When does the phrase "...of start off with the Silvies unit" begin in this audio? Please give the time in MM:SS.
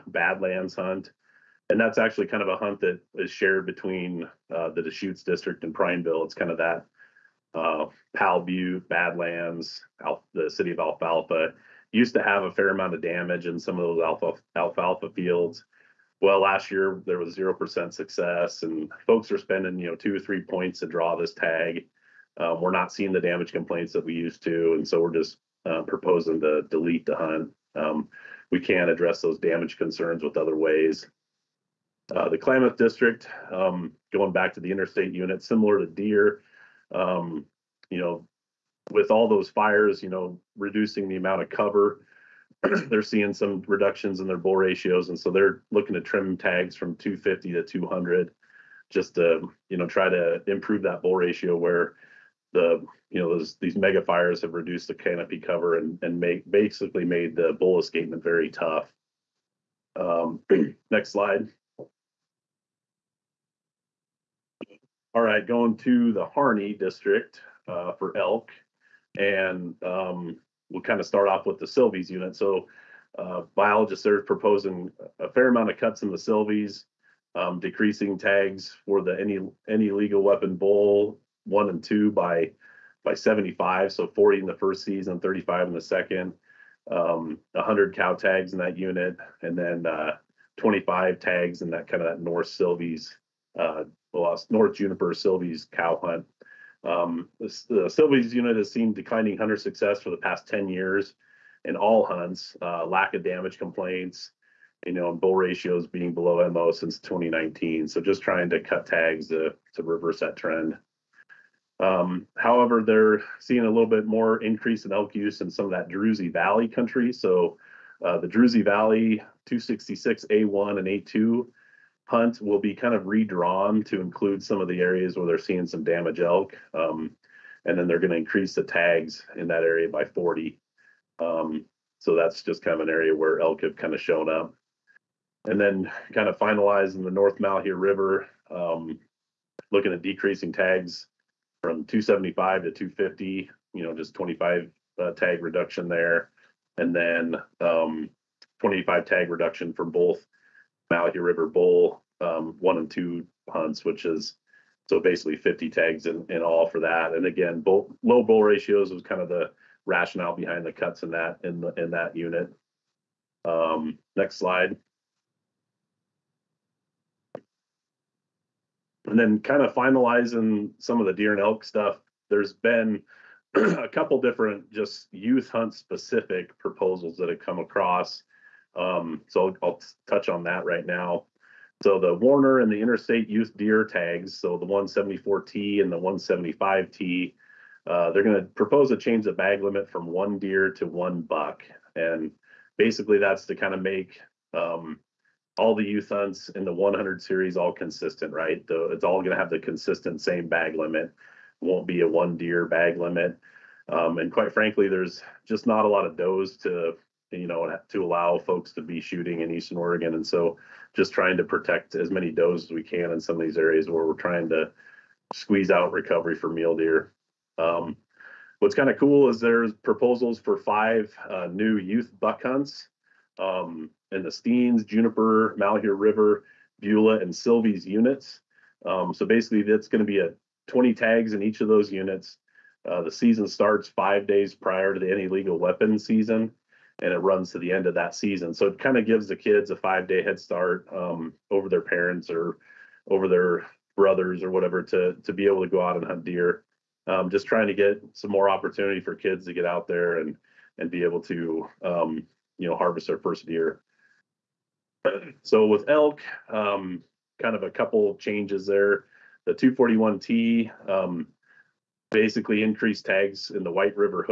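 01:11.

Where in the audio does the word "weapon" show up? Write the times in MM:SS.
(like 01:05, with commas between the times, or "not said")
01:20, 03:55.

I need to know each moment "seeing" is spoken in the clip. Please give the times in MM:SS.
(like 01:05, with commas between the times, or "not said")
00:22, 00:43, 01:53, 02:05.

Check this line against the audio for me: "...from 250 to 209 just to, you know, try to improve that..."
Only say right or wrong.
wrong.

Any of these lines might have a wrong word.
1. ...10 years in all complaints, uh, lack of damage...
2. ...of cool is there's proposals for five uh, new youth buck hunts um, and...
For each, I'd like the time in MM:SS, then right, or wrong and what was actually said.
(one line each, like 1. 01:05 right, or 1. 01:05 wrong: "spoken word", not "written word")
1. 01:40 wrong: "hunts", not "complaints"
2. 03:38 right.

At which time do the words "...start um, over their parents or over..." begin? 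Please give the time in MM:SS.
04:00.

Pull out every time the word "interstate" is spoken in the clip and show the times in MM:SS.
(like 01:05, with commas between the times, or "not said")
00:34, 03:02.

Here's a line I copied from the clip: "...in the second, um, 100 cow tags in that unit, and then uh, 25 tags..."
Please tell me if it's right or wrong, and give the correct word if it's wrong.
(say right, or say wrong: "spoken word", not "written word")
right.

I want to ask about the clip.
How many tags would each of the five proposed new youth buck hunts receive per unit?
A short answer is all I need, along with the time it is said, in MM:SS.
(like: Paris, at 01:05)
20, at 03:50.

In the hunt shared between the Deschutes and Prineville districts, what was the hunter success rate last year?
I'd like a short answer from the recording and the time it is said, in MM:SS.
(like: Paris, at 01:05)
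0%, at 00:17.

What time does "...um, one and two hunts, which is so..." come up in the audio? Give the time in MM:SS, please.
02:32.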